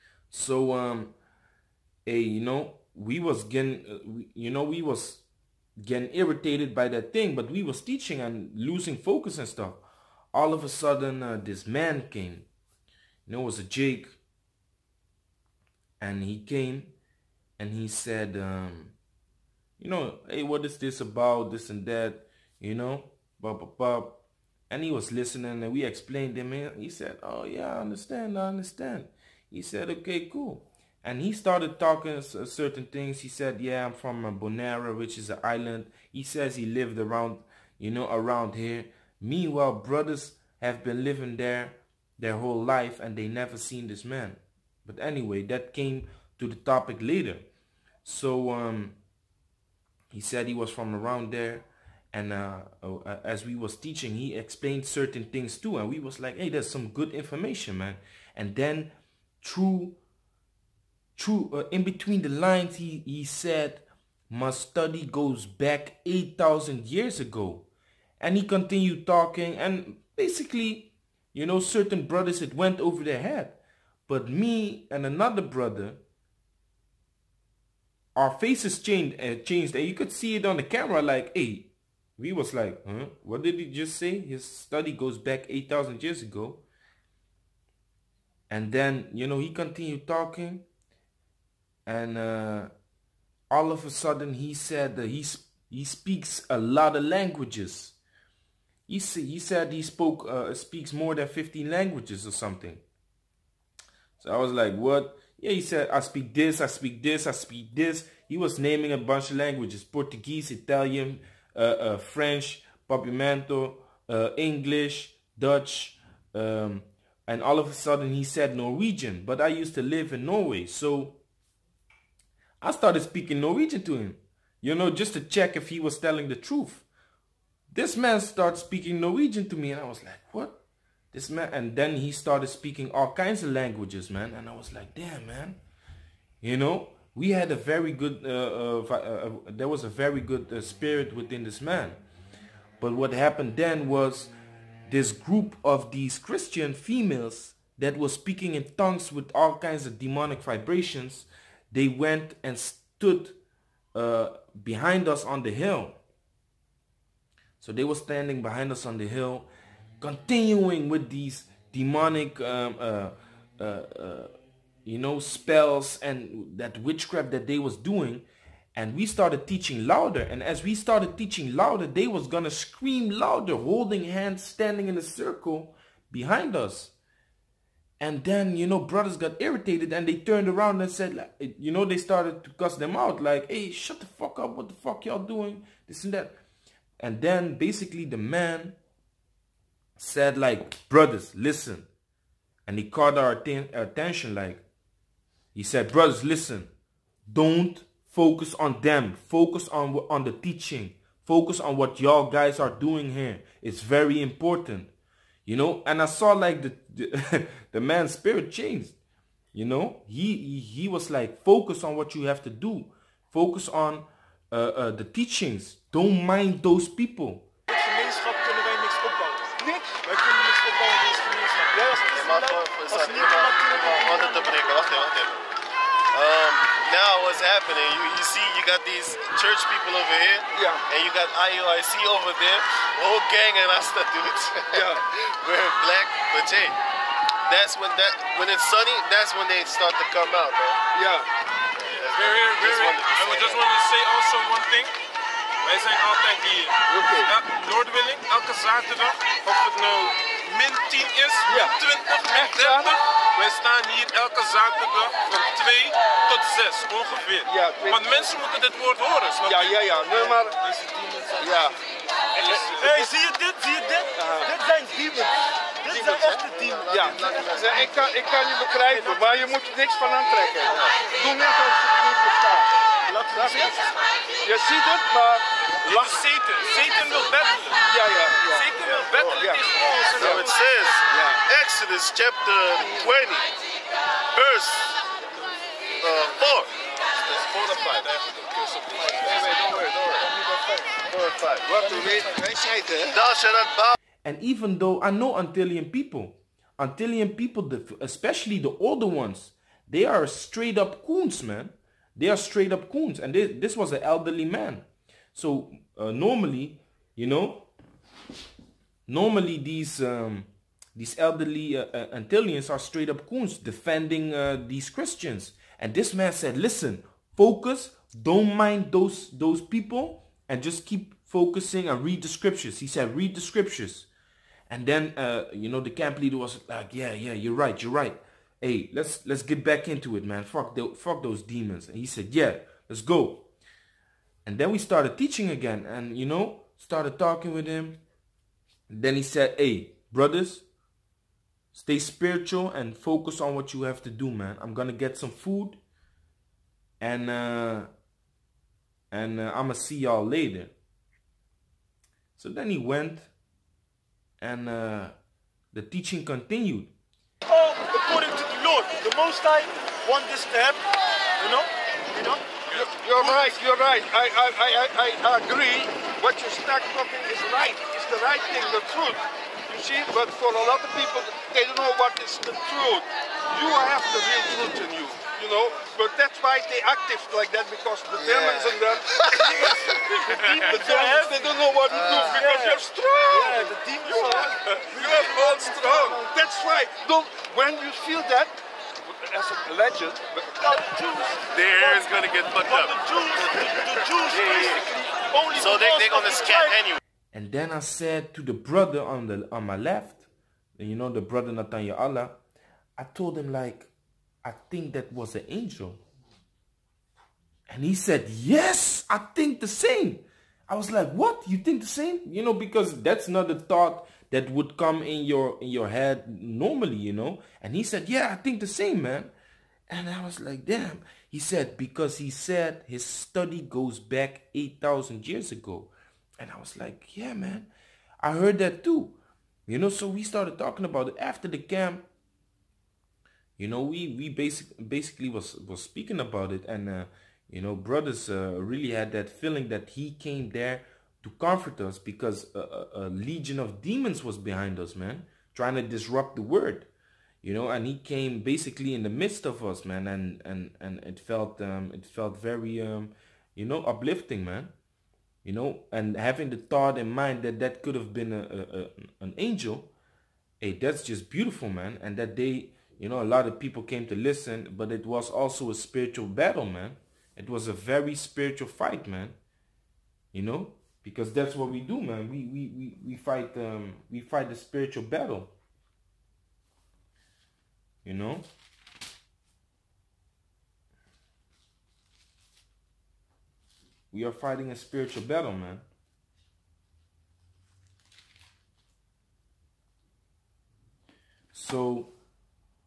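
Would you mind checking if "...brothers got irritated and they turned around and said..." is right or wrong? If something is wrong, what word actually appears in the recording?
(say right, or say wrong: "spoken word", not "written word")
right.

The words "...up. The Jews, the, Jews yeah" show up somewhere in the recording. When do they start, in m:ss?
6:32.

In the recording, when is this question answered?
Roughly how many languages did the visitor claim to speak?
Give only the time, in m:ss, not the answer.
1:40.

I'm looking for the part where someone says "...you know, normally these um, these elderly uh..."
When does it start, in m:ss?
5:07.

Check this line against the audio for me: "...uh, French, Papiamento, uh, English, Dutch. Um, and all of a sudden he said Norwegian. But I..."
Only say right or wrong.
right.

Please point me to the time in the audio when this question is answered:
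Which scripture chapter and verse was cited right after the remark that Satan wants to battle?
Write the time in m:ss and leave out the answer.
4:41.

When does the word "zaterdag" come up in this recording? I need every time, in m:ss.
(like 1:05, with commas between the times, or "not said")
4:08, 4:14.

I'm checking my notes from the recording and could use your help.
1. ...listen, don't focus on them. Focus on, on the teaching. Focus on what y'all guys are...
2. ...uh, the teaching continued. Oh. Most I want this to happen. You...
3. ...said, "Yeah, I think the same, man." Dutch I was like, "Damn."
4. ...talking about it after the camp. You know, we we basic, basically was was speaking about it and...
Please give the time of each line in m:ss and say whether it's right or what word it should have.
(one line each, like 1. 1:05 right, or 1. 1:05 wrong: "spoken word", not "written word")
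1. 3:16 right
2. 5:54 right
3. 6:57 wrong: "And", not "Dutch"
4. 7:10 right.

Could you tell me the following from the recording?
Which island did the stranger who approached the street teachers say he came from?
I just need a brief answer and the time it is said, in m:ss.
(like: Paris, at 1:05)
Bonaire, at 0:34.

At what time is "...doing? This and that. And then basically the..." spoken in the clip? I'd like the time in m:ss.
3:05.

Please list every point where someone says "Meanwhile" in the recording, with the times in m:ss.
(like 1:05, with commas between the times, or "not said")
0:39.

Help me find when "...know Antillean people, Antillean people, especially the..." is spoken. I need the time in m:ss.
4:55.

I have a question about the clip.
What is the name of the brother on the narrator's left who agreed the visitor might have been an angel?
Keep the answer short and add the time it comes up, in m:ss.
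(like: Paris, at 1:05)
Natanya Allah, at 6:41.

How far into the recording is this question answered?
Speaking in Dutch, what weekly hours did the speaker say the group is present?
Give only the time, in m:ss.
4:15.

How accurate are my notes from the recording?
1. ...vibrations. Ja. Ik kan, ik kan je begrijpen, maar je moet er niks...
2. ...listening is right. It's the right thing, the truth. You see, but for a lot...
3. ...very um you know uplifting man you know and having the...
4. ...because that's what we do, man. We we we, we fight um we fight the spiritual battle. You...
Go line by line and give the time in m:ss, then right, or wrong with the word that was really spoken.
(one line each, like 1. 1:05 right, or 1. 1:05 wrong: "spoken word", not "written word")
1. 4:26 wrong: "demons", not "vibrations"
2. 6:06 wrong: "talking", not "listening"
3. 7:32 right
4. 7:51 right.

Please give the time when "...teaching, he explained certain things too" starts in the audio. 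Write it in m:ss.
0:53.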